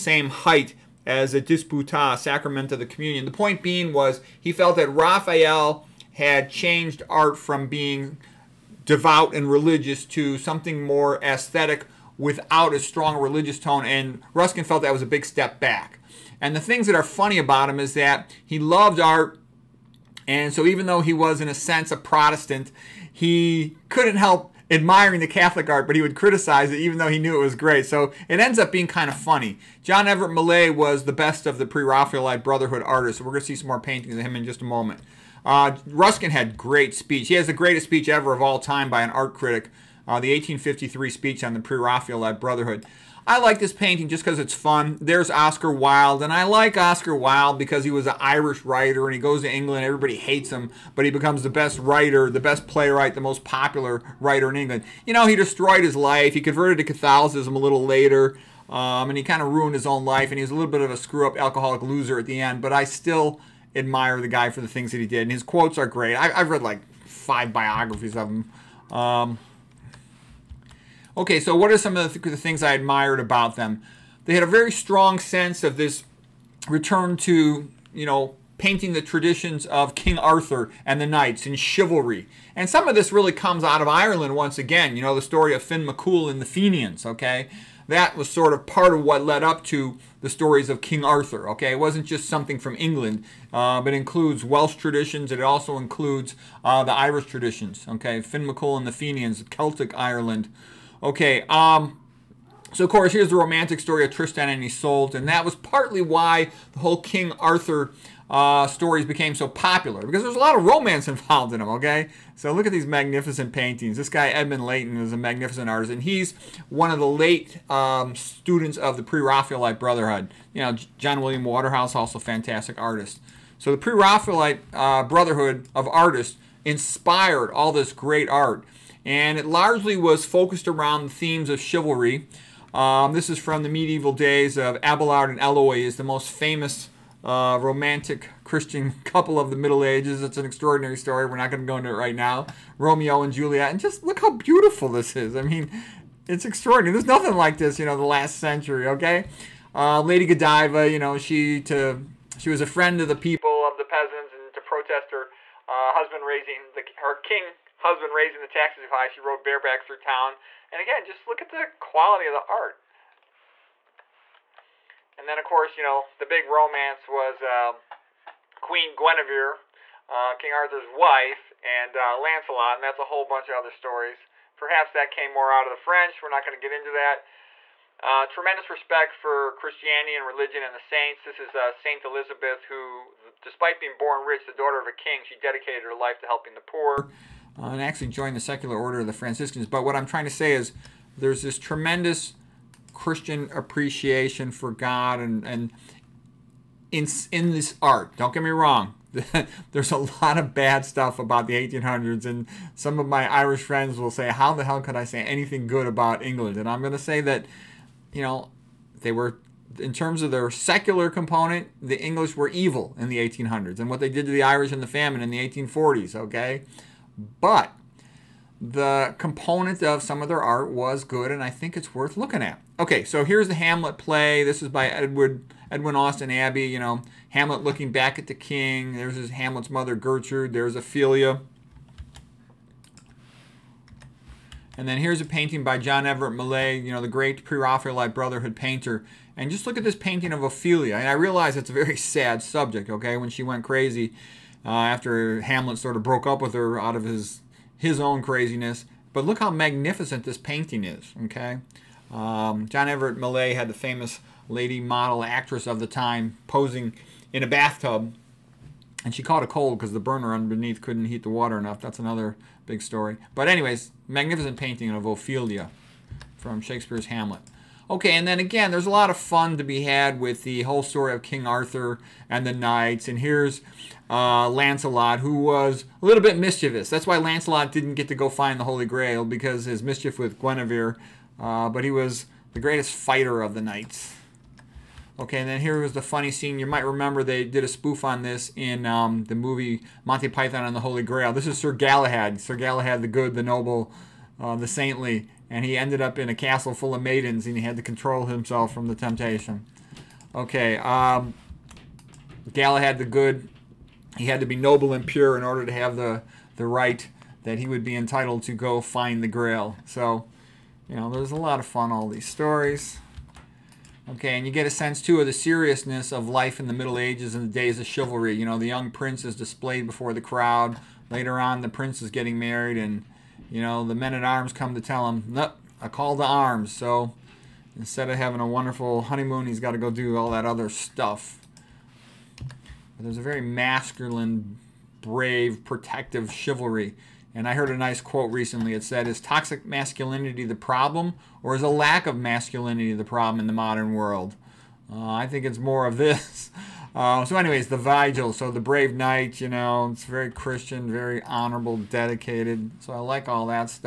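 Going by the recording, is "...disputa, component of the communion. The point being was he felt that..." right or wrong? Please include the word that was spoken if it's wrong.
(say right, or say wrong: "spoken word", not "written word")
wrong: "sacrament", not "component".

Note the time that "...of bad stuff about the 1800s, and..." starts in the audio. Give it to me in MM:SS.
03:20.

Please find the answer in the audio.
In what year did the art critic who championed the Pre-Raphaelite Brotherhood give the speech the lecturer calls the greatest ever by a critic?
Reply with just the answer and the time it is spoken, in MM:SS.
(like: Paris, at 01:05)
1853, at 00:40.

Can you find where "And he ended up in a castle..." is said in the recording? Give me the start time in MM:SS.
04:55.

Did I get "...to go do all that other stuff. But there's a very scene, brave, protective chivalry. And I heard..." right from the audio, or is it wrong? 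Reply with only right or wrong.
wrong.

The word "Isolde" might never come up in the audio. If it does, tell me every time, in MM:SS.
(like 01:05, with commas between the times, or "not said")
01:44.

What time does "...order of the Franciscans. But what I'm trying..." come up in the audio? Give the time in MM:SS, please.
03:08.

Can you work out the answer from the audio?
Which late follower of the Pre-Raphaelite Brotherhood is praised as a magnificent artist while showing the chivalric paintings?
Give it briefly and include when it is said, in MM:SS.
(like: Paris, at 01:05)
Edmund Leighton, at 01:54.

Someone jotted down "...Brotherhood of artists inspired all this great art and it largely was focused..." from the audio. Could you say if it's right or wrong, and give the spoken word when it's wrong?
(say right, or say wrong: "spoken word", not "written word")
right.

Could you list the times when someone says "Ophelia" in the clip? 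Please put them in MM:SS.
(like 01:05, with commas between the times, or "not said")
03:50, 04:00, 04:25.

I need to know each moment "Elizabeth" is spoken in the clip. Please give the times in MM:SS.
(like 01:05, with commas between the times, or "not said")
03:02.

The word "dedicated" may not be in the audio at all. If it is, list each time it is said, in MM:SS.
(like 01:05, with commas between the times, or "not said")
03:05, 05:51.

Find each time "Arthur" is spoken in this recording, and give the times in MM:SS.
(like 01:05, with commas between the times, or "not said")
01:20, 01:31, 01:47, 02:50, 04:31.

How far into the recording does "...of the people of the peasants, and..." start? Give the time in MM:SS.
02:33.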